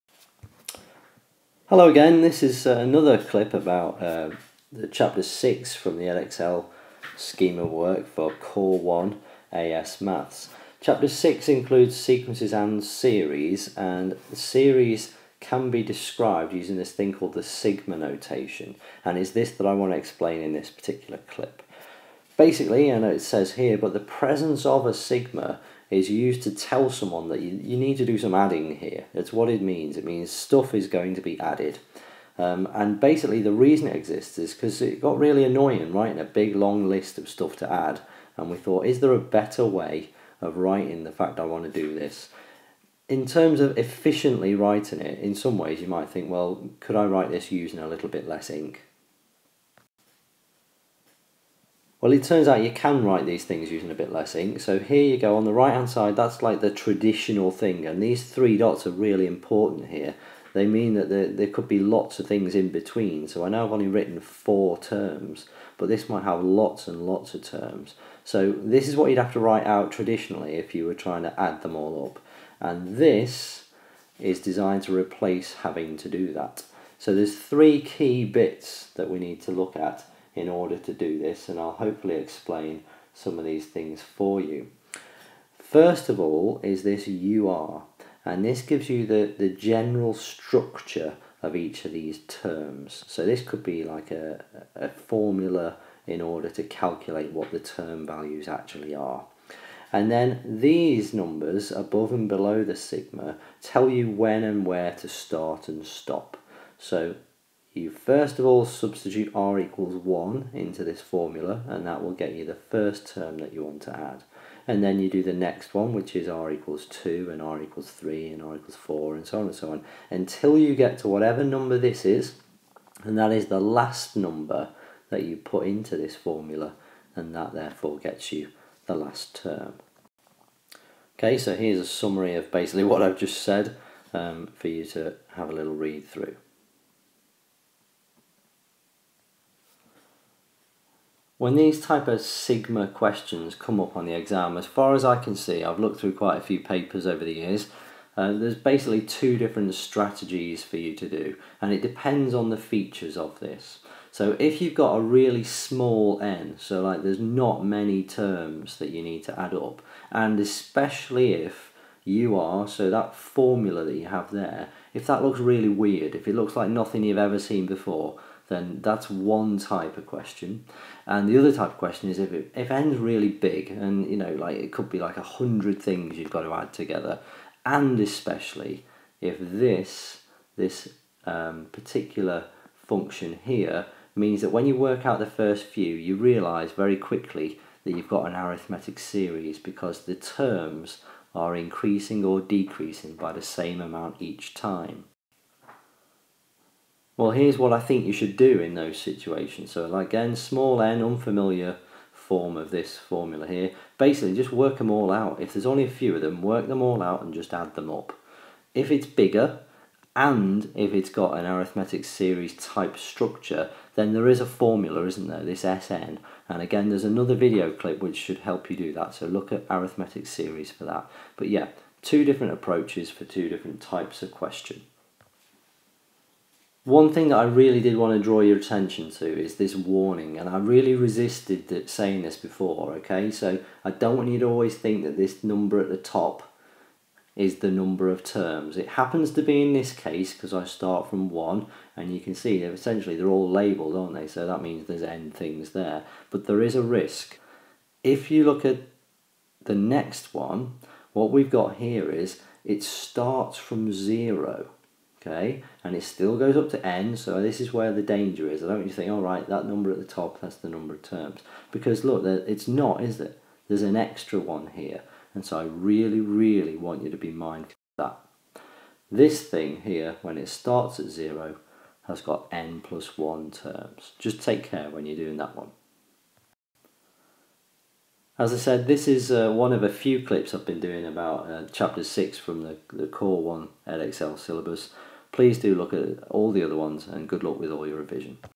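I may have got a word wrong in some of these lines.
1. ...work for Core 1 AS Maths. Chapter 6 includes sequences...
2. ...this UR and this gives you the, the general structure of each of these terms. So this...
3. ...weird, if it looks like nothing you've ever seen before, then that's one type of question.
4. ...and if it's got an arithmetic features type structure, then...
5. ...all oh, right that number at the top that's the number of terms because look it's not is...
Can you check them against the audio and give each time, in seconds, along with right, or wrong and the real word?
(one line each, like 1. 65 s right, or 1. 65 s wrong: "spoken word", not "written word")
1. 7 s right
2. 86 s right
3. 165 s right
4. 210 s wrong: "series", not "features"
5. 259 s right.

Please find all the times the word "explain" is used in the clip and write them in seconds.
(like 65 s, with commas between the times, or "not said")
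19 s, 82 s.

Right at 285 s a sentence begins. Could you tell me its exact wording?
Please do look at all the other ones and good luck with all your revision.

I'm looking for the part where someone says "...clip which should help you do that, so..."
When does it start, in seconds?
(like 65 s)
217 s.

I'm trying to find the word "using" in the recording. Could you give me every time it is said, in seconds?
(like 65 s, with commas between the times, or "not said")
16 s, 47 s, 53 s.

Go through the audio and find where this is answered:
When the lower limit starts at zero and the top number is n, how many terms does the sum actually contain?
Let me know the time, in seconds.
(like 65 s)
272 s.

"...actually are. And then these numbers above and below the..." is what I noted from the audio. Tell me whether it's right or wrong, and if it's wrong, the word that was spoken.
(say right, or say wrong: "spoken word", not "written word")
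right.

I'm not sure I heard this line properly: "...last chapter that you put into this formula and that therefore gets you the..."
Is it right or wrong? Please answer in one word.
wrong.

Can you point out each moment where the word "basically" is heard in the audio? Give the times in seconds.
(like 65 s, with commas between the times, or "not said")
22 s, 32 s, 132 s, 148 s, 203 s.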